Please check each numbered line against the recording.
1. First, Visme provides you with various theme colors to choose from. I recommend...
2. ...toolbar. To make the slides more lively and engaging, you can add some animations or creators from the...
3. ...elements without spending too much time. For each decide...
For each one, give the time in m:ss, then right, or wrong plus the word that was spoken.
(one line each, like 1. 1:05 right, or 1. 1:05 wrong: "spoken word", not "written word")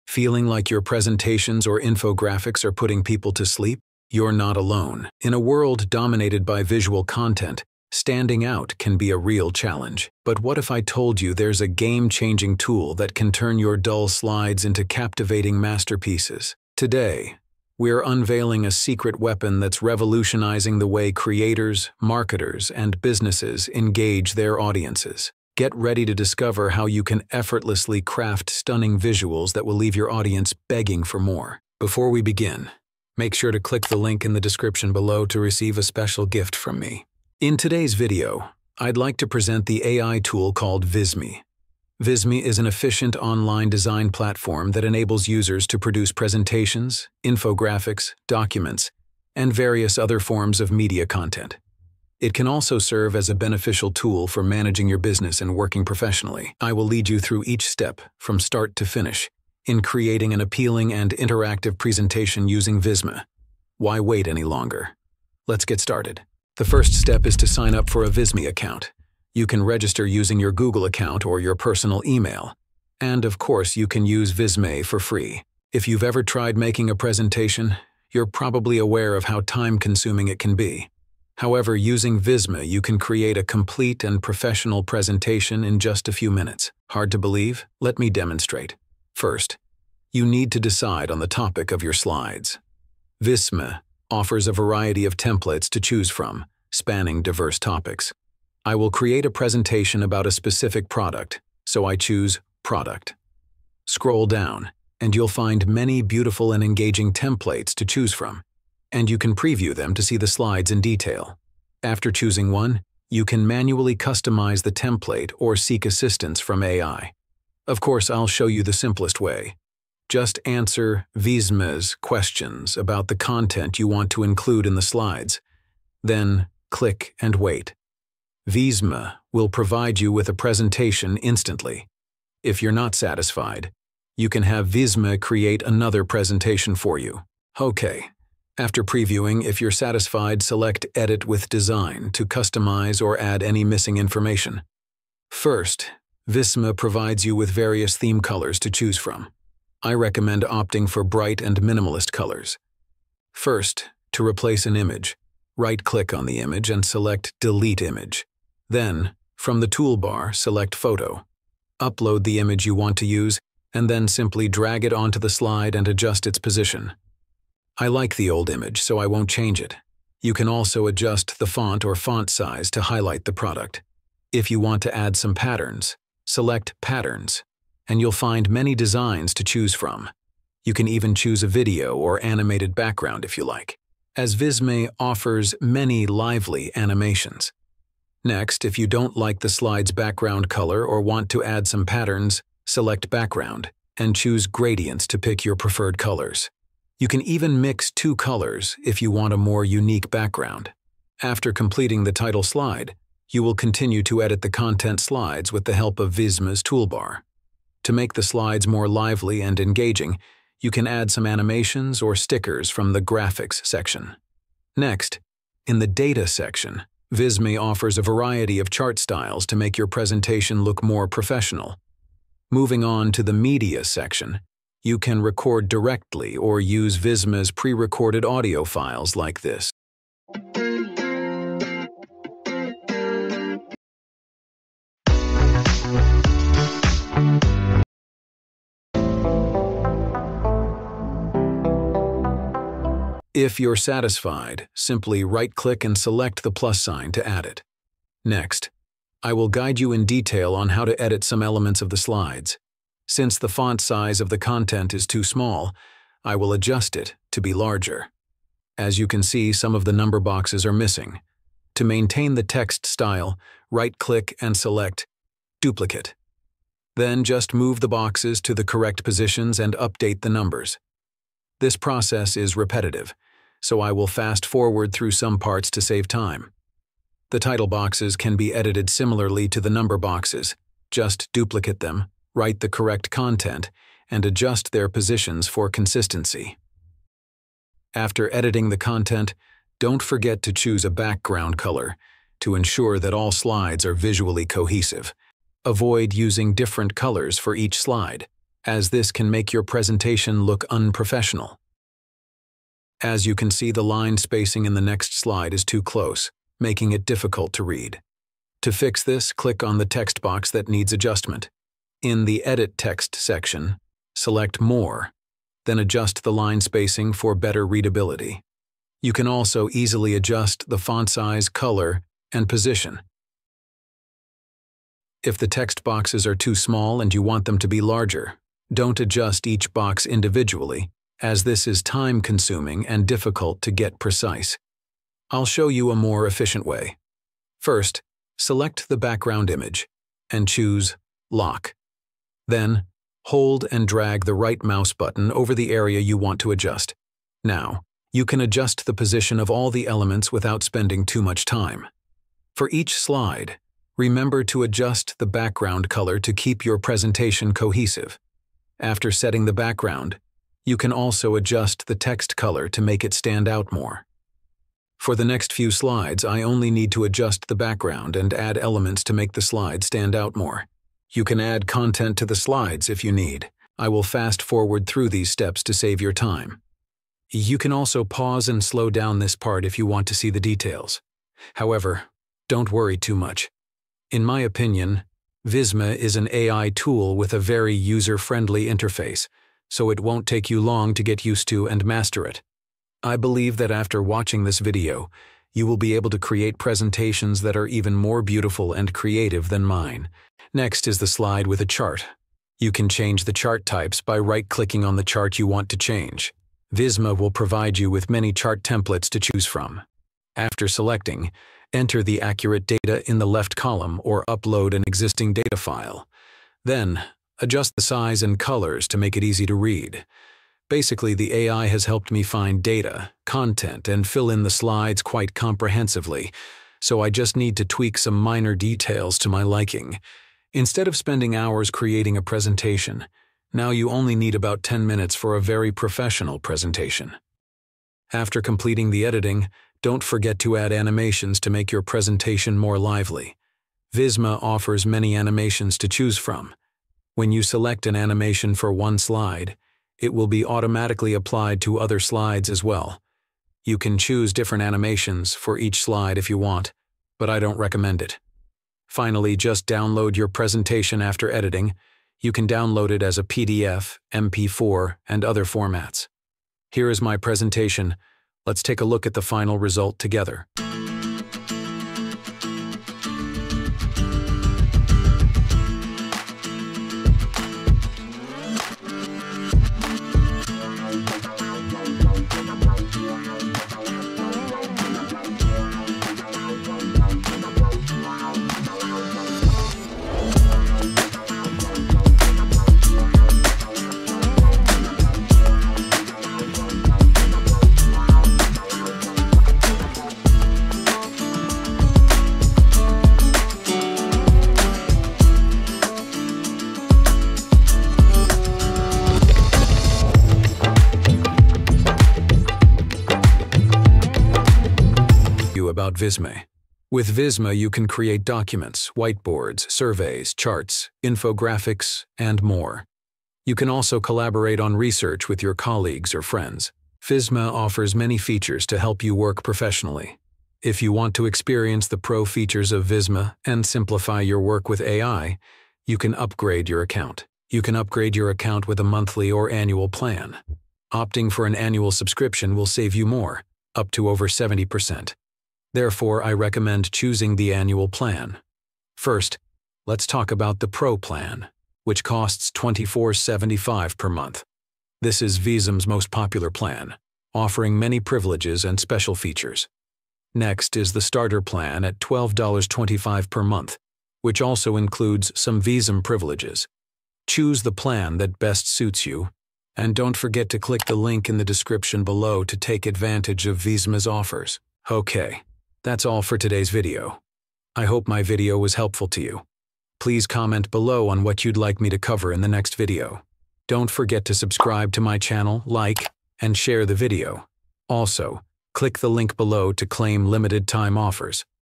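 1. 2:25 right
2. 3:26 wrong: "stickers", not "creators"
3. 5:49 wrong: "slide", not "decide".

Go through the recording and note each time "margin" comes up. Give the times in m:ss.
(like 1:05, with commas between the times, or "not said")
not said.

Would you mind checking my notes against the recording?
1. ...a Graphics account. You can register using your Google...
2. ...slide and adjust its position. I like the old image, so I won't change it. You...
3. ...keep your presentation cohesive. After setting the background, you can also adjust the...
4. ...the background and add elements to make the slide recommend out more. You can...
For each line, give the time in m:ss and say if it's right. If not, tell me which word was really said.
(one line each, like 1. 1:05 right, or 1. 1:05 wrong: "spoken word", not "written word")
1. 1:08 wrong: "Visme", not "Graphics"
2. 2:45 right
3. 5:56 right
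4. 6:07 wrong: "stand", not "recommend".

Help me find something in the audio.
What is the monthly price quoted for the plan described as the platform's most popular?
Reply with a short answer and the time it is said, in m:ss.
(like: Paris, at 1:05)
$24.75, at 9:12.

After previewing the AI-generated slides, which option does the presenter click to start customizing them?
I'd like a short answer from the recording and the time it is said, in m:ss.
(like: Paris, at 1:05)
Edit with Design, at 2:20.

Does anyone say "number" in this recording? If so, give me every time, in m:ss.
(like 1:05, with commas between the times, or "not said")
4:19, 4:30, 4:39.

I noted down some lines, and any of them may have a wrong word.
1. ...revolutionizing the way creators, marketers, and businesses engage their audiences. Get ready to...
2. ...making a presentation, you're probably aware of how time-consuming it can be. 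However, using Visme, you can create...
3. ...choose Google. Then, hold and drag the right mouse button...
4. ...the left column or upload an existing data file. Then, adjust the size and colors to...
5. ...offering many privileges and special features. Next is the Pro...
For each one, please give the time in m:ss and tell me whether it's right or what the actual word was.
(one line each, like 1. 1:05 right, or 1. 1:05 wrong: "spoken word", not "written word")
1. 0:19 right
2. 1:16 right
3. 5:40 wrong: "Lock", not "Google"
4. 6:53 right
5. 9:17 wrong: "Starter", not "Pro".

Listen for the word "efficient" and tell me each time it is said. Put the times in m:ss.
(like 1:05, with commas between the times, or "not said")
0:42, 5:36.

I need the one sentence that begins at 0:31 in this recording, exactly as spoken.
Before we begin, make sure to click the link in the description below to receive a special gift from me.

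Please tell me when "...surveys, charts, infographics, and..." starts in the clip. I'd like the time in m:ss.
8:39.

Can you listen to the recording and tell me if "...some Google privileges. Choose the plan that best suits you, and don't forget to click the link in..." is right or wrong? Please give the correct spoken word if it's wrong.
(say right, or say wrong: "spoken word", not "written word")
wrong: "Visme", not "Google".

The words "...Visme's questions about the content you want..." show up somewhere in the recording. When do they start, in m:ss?
2:01.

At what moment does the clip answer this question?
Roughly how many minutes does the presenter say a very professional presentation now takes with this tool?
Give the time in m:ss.
7:14.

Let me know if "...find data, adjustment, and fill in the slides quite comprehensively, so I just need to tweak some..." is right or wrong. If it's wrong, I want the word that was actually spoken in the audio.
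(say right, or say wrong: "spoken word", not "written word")
wrong: "content", not "adjustment".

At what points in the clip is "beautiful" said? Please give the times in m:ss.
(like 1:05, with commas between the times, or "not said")
1:46, 6:38.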